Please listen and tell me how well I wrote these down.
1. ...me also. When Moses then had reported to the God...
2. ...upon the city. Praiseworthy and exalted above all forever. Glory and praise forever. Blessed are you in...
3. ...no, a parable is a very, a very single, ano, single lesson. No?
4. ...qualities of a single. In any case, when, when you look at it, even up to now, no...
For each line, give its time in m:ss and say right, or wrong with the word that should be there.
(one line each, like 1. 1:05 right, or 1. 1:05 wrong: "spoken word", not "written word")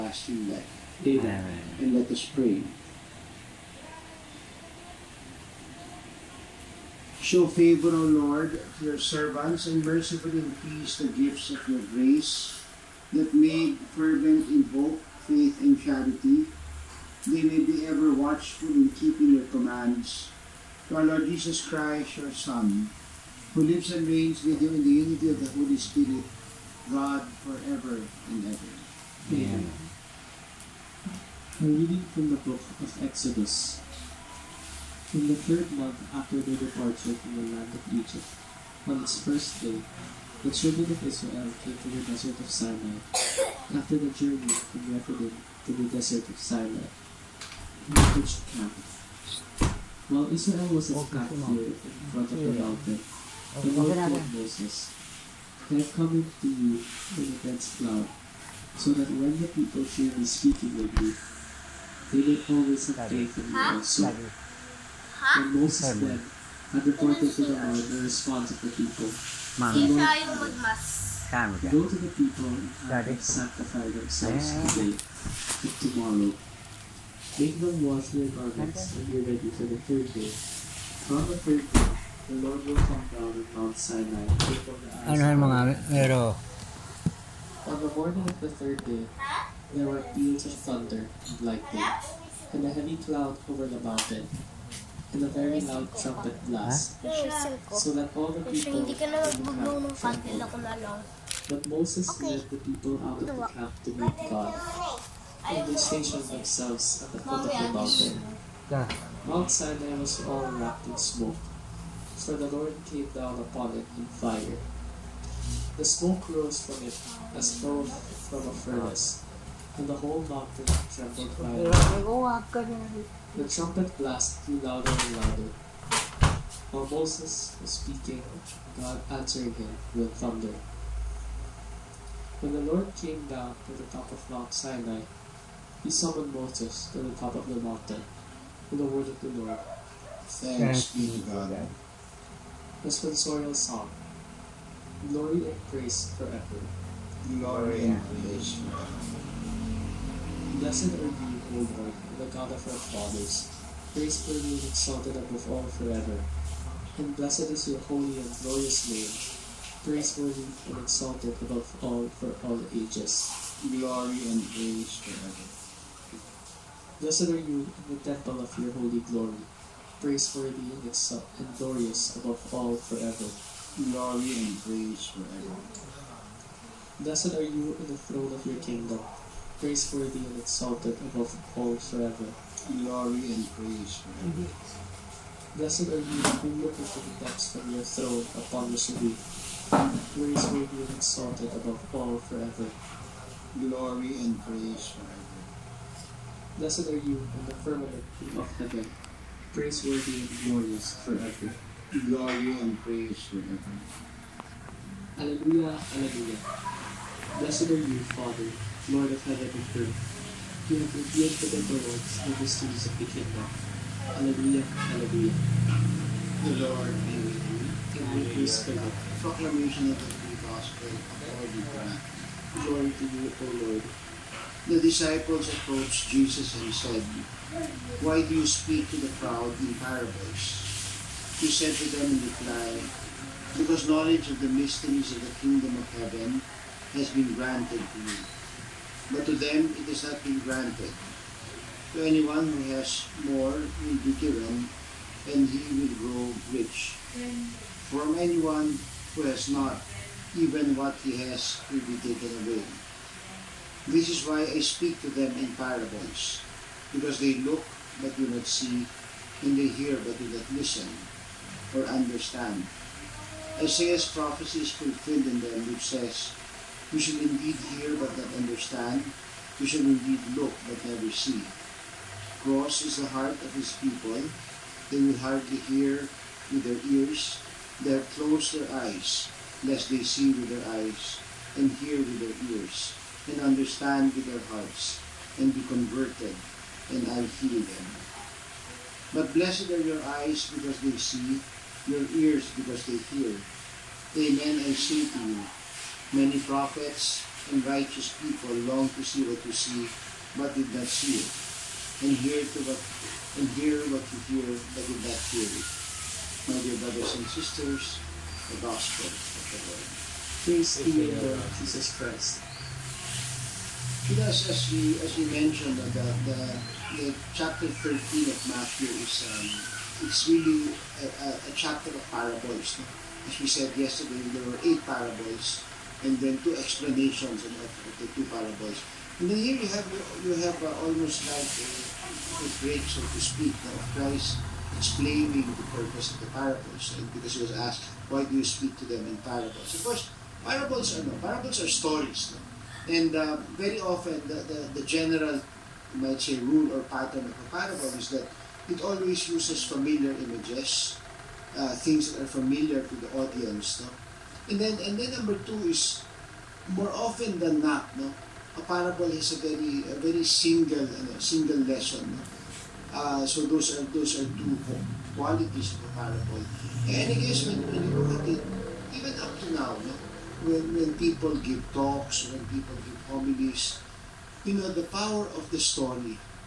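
1. 1:03 wrong: "Lord", not "God"
2. 3:08 right
3. 5:57 right
4. 6:05 wrong: "parable", not "single".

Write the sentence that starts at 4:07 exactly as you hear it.
From anyone who has not, even what he has will be taken away.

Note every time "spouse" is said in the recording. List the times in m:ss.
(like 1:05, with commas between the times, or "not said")
not said.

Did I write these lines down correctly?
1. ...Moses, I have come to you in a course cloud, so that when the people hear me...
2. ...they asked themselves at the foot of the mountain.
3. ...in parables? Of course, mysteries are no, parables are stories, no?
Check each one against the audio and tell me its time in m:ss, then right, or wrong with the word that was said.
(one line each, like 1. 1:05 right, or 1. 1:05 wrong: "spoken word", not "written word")
1. 0:54 wrong: "dense", not "course"
2. 1:45 wrong: "stationed", not "asked"
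3. 5:39 wrong: "parables", not "mysteries".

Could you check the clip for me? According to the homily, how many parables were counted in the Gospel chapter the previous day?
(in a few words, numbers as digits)
8.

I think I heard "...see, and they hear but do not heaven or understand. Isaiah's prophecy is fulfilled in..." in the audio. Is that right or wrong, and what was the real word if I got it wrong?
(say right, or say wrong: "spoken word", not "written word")
wrong: "listen", not "heaven".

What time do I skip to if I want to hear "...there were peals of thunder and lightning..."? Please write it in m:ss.
1:29.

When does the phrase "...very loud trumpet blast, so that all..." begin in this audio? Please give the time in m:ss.
1:35.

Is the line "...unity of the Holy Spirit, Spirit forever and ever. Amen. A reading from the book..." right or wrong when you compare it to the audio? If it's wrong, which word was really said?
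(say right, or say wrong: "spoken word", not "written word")
wrong: "God", not "Spirit".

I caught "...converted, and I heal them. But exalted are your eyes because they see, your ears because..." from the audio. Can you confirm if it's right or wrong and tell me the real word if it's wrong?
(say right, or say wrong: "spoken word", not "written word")
wrong: "blessed", not "exalted".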